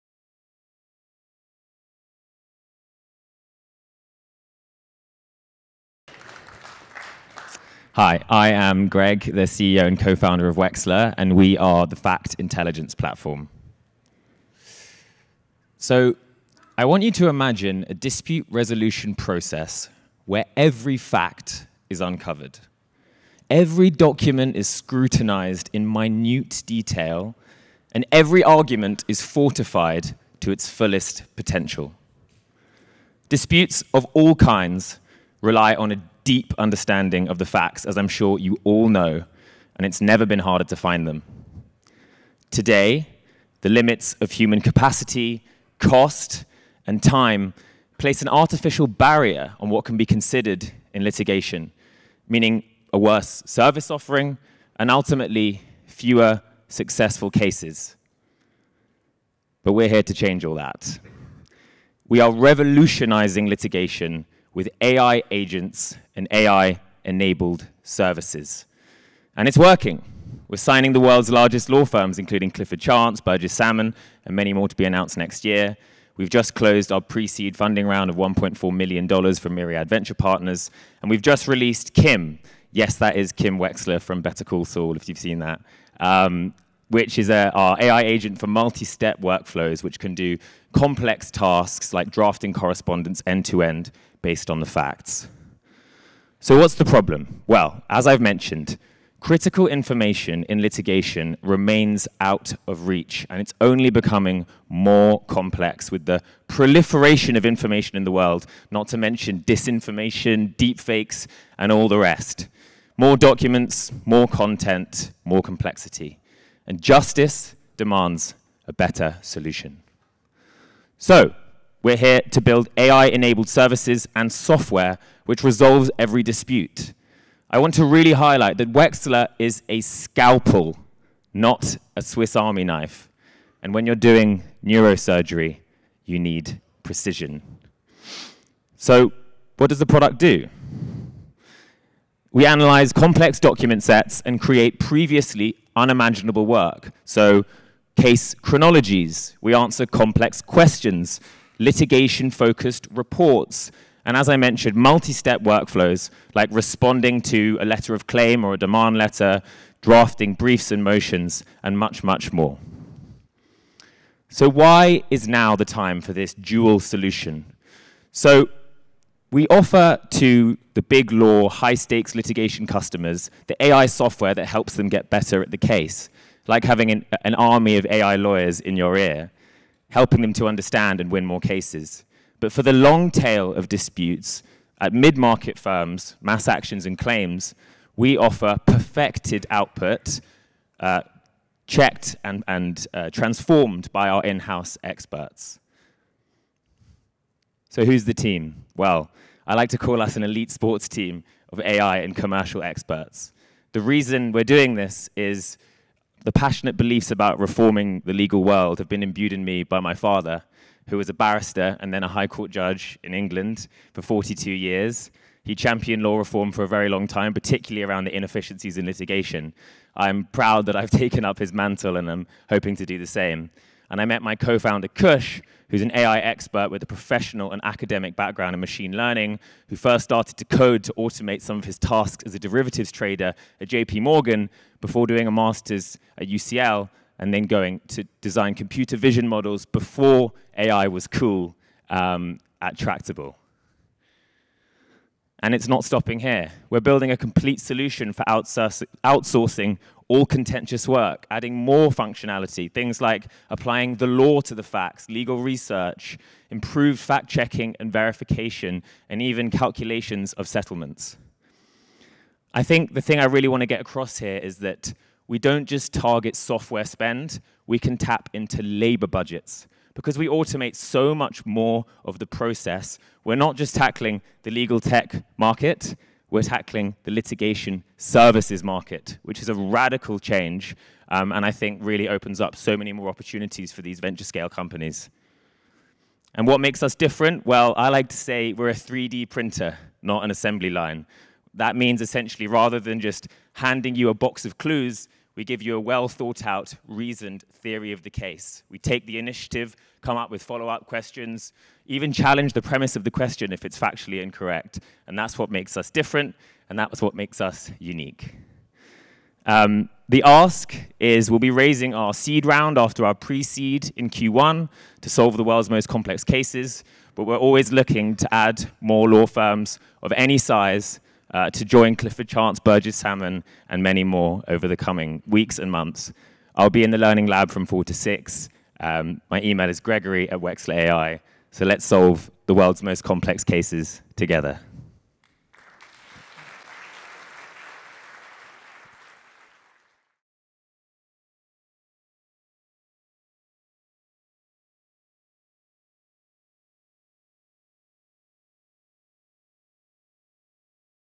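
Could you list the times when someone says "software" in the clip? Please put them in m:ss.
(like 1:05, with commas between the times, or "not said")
2:04, 2:53, 4:26.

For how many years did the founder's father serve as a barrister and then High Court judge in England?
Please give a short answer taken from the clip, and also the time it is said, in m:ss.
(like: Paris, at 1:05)
42, at 3:34.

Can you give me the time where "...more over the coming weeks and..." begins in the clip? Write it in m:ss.
5:24.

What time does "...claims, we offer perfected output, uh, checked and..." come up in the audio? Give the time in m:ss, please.
3:06.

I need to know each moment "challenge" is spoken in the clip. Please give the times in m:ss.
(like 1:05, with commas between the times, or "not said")
5:02.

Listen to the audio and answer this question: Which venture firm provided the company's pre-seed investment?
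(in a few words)
Myriad Venture Partners.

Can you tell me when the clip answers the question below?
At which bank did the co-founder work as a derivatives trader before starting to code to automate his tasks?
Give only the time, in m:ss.
3:53.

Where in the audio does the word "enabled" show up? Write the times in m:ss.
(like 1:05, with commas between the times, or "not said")
1:06, 2:02.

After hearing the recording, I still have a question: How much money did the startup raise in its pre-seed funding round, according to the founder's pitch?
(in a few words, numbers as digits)
$1.4 million.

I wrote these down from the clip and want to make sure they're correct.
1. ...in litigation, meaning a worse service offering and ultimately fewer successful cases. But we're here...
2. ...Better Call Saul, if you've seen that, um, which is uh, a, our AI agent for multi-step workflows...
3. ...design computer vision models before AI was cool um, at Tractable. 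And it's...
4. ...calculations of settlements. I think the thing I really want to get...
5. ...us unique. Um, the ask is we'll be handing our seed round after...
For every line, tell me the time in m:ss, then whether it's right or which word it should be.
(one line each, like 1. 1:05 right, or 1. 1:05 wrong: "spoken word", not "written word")
1. 0:50 right
2. 1:24 right
3. 3:58 right
4. 4:19 right
5. 5:07 wrong: "raising", not "handing".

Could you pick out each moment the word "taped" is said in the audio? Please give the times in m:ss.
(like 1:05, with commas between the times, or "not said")
not said.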